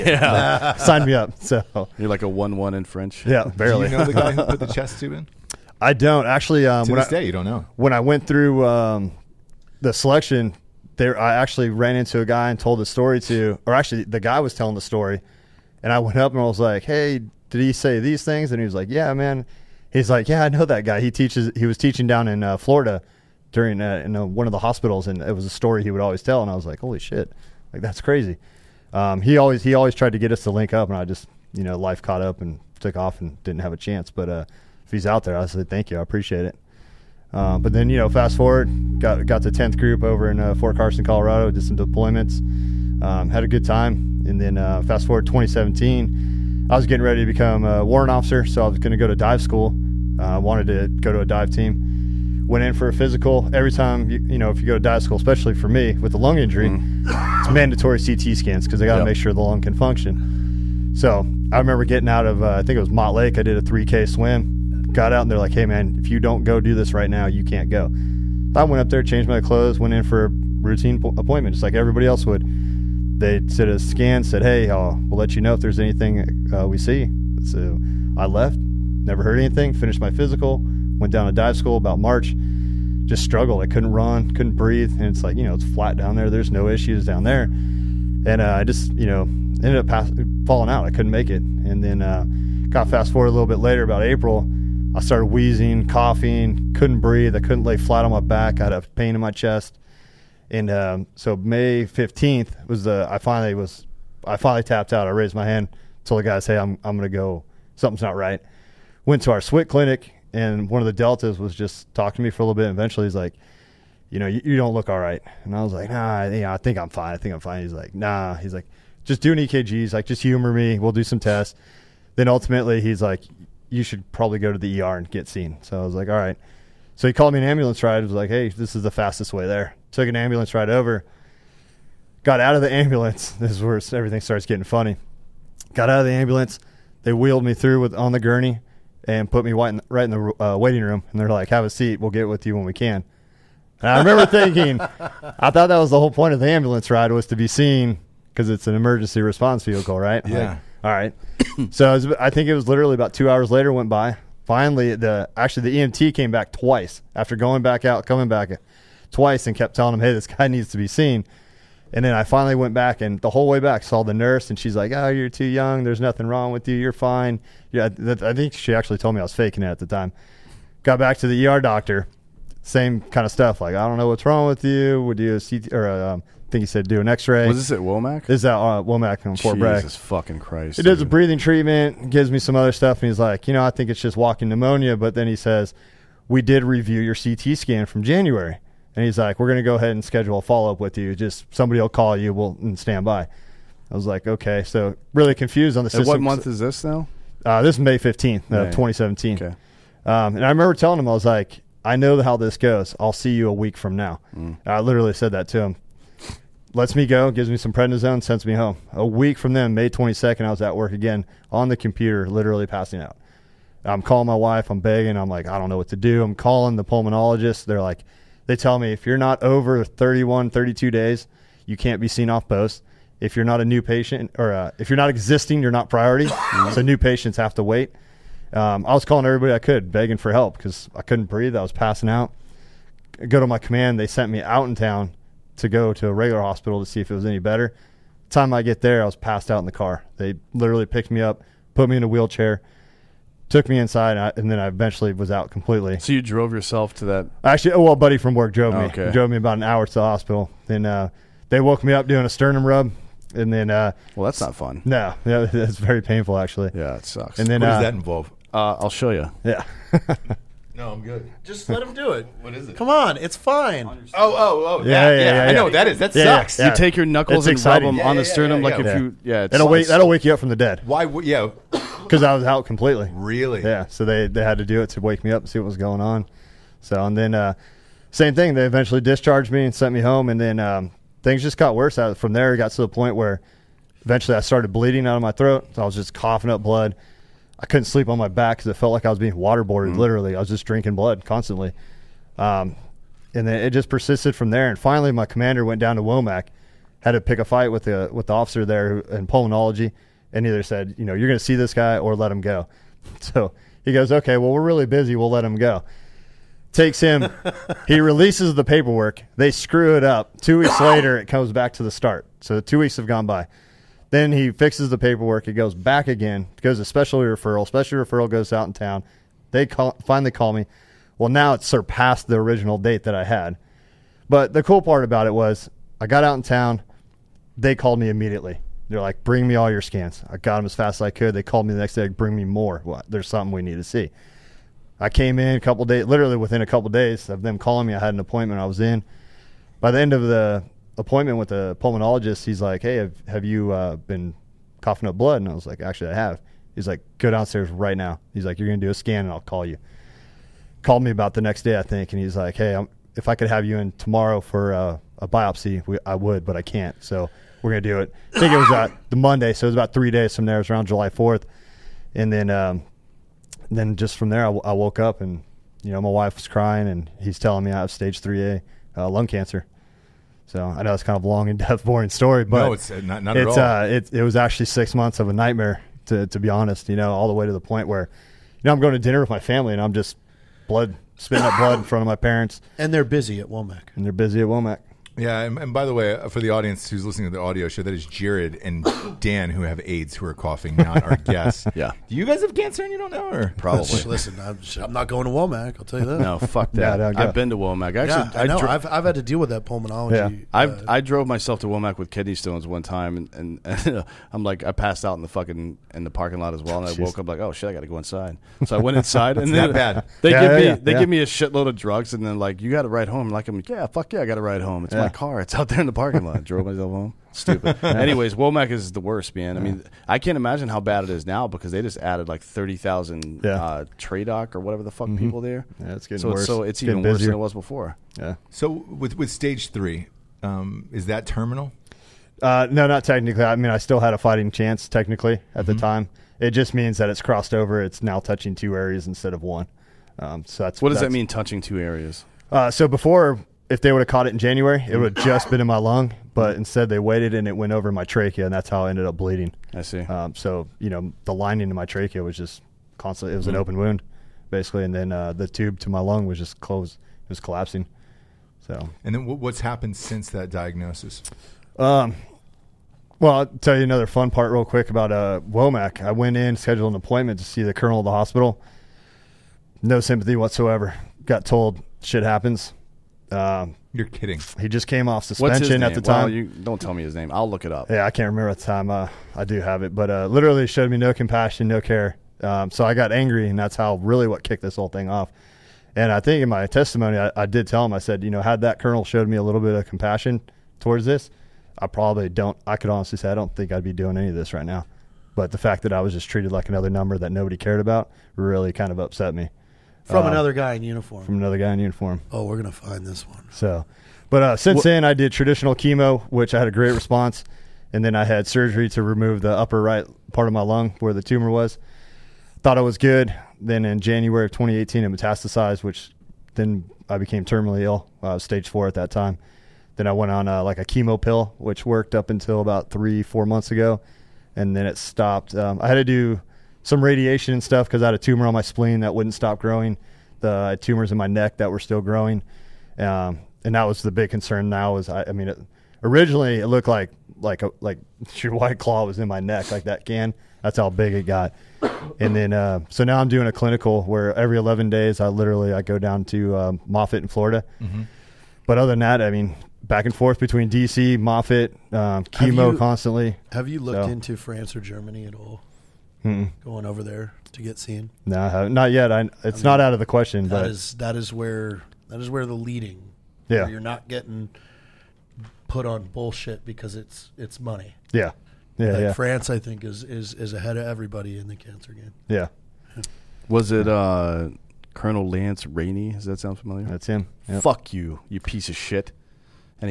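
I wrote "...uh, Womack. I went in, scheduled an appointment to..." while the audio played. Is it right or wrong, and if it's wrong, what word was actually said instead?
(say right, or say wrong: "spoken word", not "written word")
right.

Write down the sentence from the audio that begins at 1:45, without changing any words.
I raised my hand, told the guys, "Hey, I'm I'm gonna go.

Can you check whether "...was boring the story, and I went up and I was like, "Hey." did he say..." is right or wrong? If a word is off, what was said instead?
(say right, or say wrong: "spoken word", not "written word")
wrong: "telling", not "boring".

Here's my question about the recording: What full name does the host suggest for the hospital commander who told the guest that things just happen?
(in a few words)
Lance Rainey.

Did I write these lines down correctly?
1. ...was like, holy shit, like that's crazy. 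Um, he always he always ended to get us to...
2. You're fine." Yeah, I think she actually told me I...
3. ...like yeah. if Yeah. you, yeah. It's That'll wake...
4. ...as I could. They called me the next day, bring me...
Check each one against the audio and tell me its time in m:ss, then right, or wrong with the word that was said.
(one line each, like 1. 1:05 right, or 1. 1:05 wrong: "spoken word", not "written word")
1. 0:26 wrong: "tried", not "ended"
2. 2:46 right
3. 4:28 right
4. 5:30 right.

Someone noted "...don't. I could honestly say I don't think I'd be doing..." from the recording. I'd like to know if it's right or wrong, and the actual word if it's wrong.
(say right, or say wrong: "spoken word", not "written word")
right.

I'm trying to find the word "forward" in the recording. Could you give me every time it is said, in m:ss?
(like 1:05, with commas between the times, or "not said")
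0:38, 0:45, 1:33.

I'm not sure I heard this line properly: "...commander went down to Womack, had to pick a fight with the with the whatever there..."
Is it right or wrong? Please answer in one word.
wrong.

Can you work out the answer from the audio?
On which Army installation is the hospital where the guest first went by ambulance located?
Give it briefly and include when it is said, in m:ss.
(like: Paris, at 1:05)
Fort Bragg, at 2:59.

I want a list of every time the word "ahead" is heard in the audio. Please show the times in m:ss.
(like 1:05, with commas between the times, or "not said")
3:09, 9:30.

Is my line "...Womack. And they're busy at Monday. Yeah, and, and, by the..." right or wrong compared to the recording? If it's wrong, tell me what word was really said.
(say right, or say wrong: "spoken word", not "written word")
wrong: "Womack", not "Monday".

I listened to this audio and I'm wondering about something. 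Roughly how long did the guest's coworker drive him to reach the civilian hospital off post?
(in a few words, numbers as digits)
About an hour.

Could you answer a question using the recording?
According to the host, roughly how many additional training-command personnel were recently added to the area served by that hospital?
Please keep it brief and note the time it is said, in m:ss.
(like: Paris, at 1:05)
30,000, at 7:02.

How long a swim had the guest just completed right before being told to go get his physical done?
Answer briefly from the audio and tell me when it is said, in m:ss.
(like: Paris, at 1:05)
3K, at 1:03.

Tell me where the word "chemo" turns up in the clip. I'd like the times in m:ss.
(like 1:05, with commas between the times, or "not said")
8:25, 8:40, 9:12.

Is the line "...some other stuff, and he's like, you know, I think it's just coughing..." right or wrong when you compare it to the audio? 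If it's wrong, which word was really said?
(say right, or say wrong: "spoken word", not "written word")
wrong: "walking", not "coughing".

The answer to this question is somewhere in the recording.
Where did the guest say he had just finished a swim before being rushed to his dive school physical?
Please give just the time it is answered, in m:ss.
1:02.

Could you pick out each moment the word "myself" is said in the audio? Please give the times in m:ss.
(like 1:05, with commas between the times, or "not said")
6:41, 6:56.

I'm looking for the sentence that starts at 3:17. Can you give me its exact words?
Uh, this is May fifteenth, uh, twenty seventeen.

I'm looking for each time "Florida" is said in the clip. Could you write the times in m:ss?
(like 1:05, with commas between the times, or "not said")
0:22, 9:07.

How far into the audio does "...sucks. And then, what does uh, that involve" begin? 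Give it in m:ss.
4:17.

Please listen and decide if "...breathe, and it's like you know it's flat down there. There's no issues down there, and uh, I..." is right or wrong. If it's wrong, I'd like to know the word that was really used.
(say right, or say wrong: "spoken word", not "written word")
right.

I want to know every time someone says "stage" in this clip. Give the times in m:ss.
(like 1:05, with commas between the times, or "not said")
6:07, 7:09, 8:38.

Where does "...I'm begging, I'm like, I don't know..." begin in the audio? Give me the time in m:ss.
3:34.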